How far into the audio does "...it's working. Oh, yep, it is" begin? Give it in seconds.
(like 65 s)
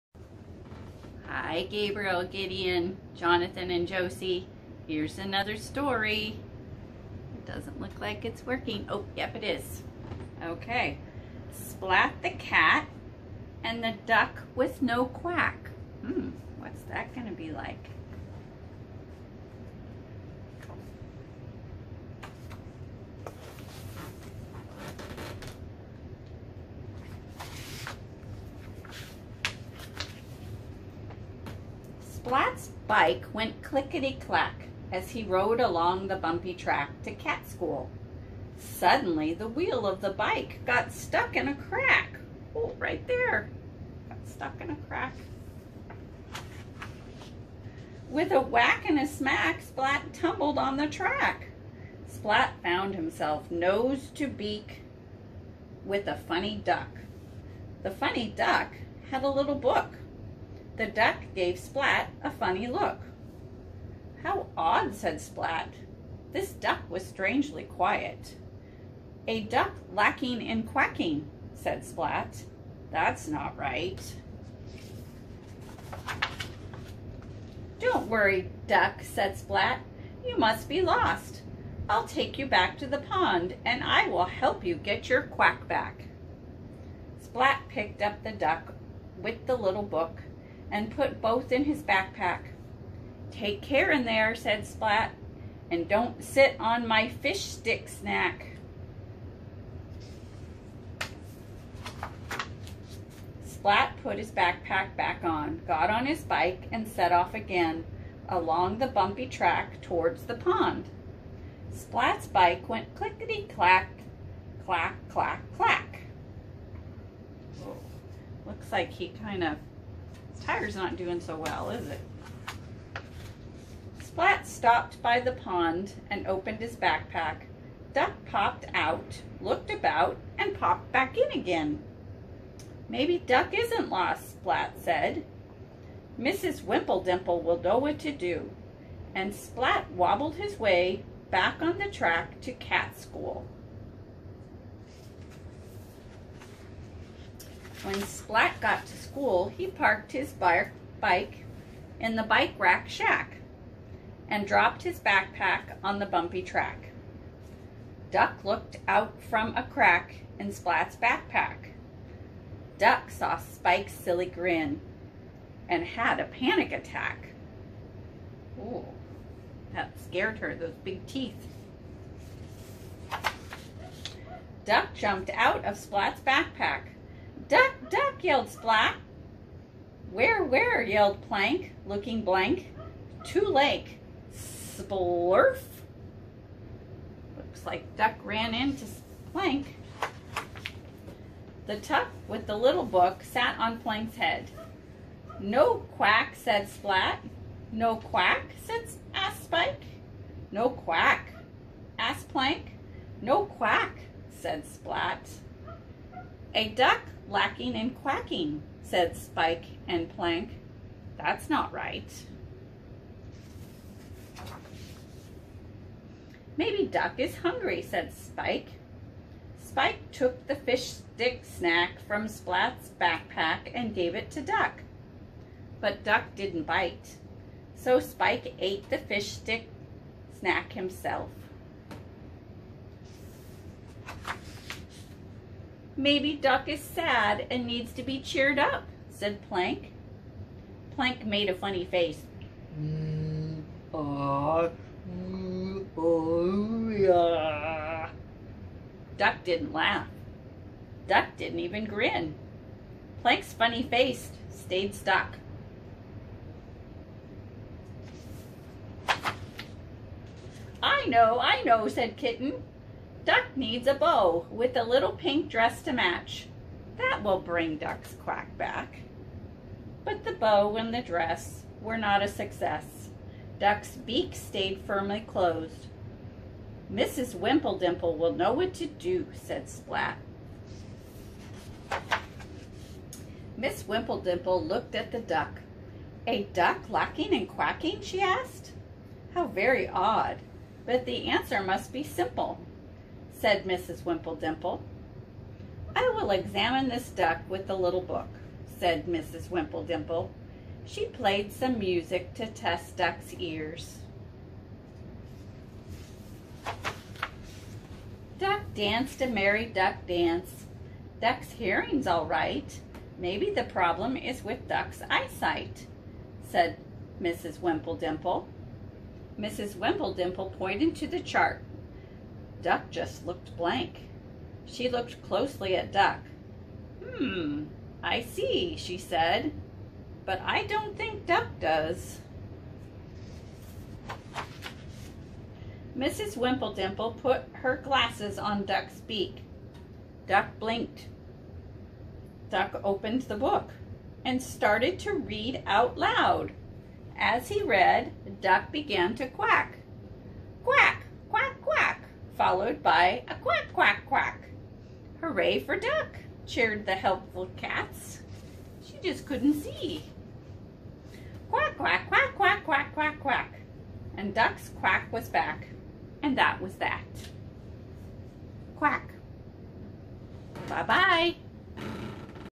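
8 s.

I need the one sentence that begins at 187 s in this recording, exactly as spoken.
Looks like Duck ran into Plank.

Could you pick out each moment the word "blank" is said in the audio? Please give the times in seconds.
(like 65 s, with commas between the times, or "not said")
182 s, 323 s.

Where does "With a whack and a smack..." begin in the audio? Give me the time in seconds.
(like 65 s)
48 s.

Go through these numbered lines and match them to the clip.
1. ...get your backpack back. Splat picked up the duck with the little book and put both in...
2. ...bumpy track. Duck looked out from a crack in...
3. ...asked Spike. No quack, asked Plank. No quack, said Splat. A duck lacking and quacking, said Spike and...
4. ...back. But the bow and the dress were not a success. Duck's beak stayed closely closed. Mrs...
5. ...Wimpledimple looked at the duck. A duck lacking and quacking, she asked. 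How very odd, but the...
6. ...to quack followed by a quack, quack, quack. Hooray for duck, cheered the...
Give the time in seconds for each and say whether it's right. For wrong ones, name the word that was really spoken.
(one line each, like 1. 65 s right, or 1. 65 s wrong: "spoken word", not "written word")
1. 84 s wrong: "quack", not "backpack"
2. 156 s right
3. 199 s right
4. 268 s wrong: "firmly", not "closely"
5. 283 s right
6. 349 s right.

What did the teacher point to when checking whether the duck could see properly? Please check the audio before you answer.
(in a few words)
The chart.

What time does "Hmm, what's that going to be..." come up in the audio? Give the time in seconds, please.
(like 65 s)
16 s.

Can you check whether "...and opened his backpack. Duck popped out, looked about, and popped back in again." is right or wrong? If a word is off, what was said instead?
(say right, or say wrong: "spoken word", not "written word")
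right.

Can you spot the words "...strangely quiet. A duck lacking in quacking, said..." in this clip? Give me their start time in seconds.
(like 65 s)
67 s.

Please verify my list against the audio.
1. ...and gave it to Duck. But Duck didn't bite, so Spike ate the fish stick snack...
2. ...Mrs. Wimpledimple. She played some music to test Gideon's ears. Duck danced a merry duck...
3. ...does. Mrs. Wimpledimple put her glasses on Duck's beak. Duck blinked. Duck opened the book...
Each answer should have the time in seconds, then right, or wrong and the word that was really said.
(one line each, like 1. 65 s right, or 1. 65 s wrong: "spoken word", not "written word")
1. 223 s right
2. 299 s wrong: "Duck", not "Gideon"
3. 331 s right.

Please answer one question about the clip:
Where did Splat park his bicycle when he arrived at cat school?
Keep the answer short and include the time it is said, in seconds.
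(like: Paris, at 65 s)
Bike rack shack, at 152 s.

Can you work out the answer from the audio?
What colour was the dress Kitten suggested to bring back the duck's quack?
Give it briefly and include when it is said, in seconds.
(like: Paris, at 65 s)
Pink, at 265 s.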